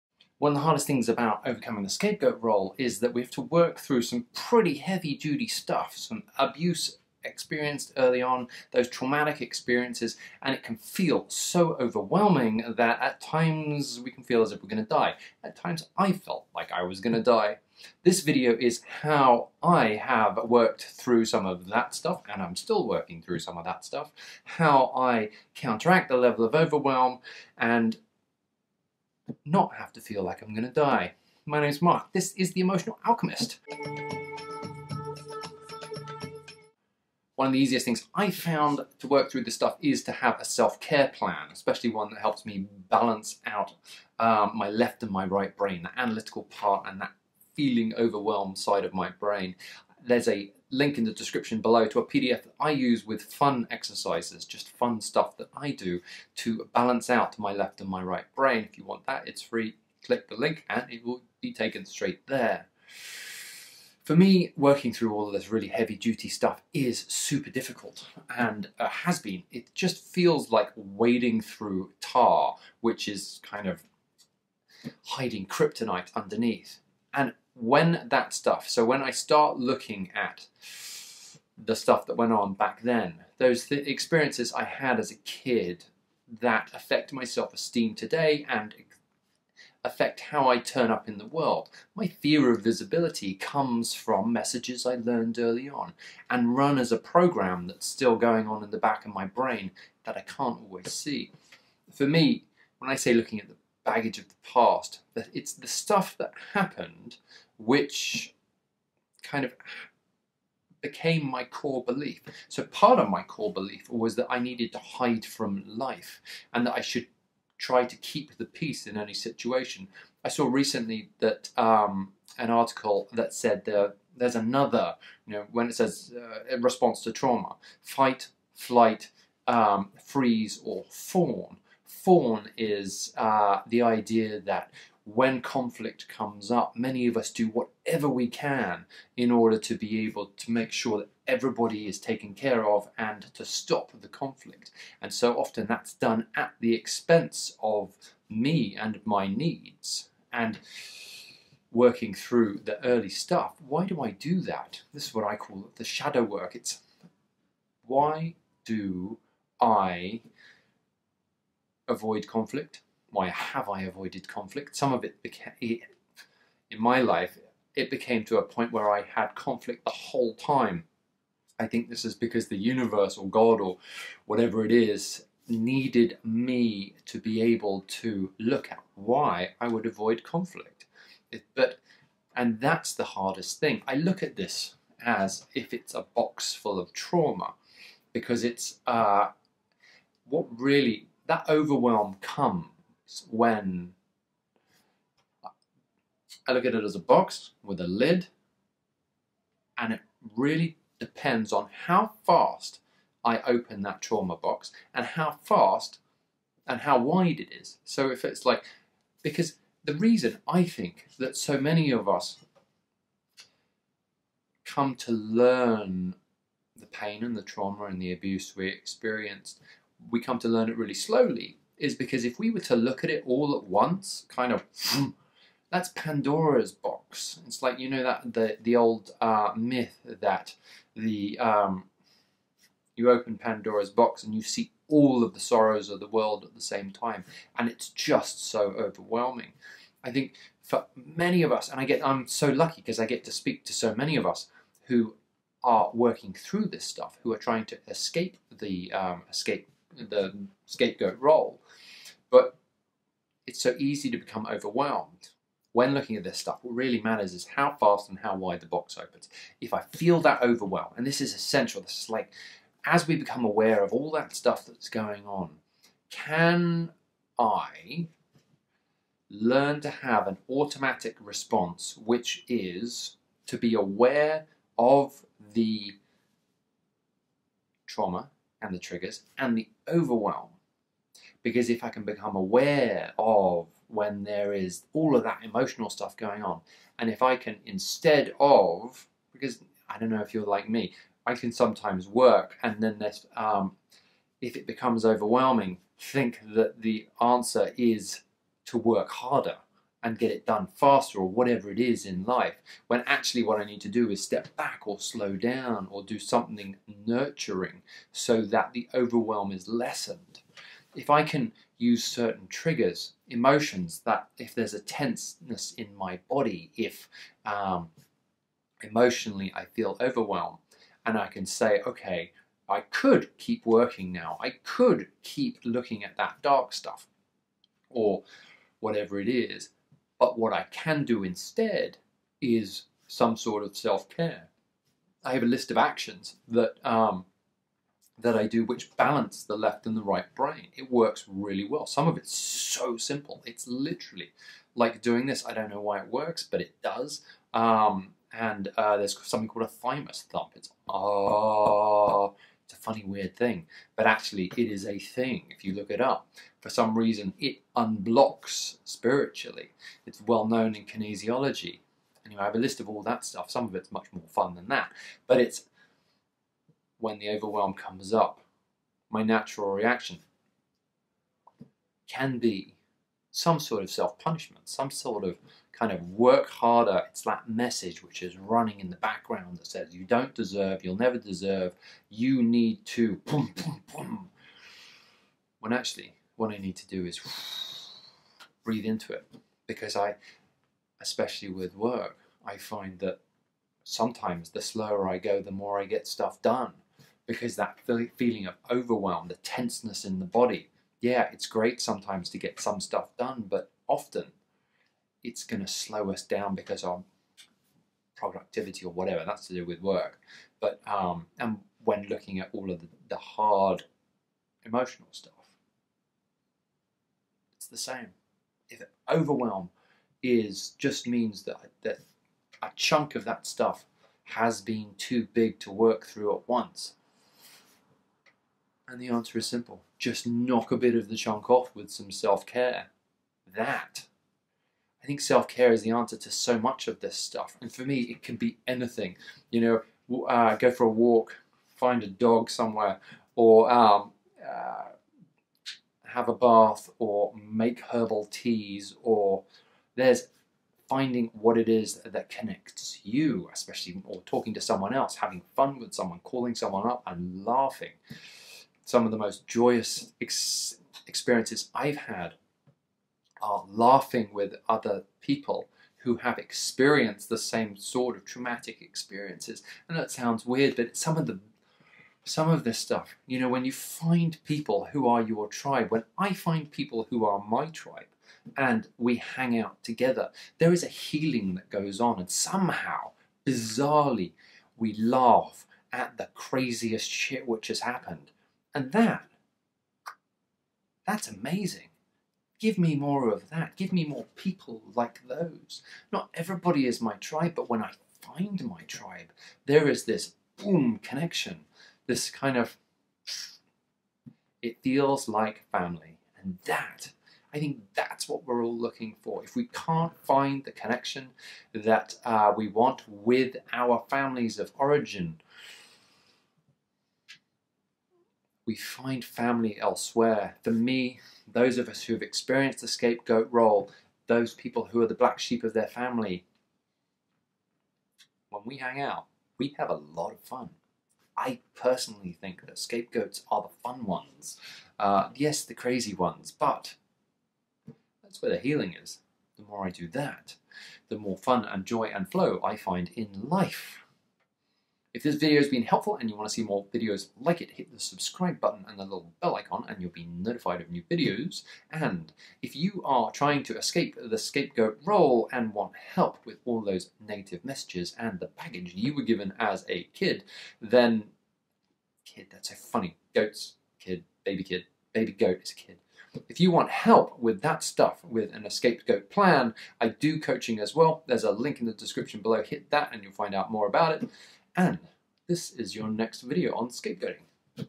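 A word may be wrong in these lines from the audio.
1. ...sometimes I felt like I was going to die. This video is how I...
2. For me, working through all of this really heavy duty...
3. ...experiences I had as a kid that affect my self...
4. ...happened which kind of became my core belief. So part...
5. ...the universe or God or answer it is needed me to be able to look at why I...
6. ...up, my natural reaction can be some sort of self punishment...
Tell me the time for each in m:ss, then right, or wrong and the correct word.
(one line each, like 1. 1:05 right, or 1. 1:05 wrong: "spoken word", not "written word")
1. 0:15 wrong: "times", not "sometimes"
2. 1:04 right
3. 1:23 right
4. 1:46 right
5. 2:52 wrong: "whatever", not "answer"
6. 6:08 right.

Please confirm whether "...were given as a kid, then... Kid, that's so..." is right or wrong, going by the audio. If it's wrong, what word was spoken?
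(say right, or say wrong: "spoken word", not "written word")
right.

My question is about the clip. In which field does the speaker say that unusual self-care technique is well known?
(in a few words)
Kinesiology.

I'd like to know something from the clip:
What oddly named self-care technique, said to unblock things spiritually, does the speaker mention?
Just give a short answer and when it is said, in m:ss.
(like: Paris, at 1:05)
Thymus thump, at 5:49.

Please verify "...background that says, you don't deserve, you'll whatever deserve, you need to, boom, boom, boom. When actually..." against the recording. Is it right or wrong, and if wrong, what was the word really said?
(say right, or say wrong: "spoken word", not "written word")
wrong: "never", not "whatever".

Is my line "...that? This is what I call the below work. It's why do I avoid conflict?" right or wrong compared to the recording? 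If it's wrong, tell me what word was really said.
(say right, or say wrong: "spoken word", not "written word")
wrong: "shadow", not "below".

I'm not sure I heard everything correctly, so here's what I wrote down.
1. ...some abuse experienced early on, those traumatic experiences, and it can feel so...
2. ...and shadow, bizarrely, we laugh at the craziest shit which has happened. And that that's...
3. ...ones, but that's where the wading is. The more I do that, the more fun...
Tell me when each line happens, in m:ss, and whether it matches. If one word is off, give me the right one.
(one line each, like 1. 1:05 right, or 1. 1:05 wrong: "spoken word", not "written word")
1. 0:05 right
2. 8:02 wrong: "somehow", not "shadow"
3. 8:56 wrong: "healing", not "wading".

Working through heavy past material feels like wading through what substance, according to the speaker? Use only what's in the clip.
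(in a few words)
Tar.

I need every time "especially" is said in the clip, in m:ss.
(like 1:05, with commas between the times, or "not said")
0:41, 6:31, 7:33.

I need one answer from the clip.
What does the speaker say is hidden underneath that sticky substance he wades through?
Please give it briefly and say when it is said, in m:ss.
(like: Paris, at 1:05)
Kryptonite, at 1:15.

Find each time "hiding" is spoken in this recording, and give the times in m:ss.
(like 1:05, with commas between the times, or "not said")
1:15.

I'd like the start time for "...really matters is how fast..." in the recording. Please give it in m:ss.
4:16.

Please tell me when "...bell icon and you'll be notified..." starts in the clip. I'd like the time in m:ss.
9:09.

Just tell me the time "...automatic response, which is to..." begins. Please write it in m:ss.
4:30.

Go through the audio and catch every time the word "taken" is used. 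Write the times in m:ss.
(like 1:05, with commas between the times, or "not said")
1:01, 2:21.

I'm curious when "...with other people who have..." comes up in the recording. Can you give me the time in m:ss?
7:44.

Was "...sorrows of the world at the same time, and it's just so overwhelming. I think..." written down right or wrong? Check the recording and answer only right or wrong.
right.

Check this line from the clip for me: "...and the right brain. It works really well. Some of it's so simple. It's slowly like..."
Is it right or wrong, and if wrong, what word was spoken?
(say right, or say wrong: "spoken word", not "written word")
wrong: "literally", not "slowly".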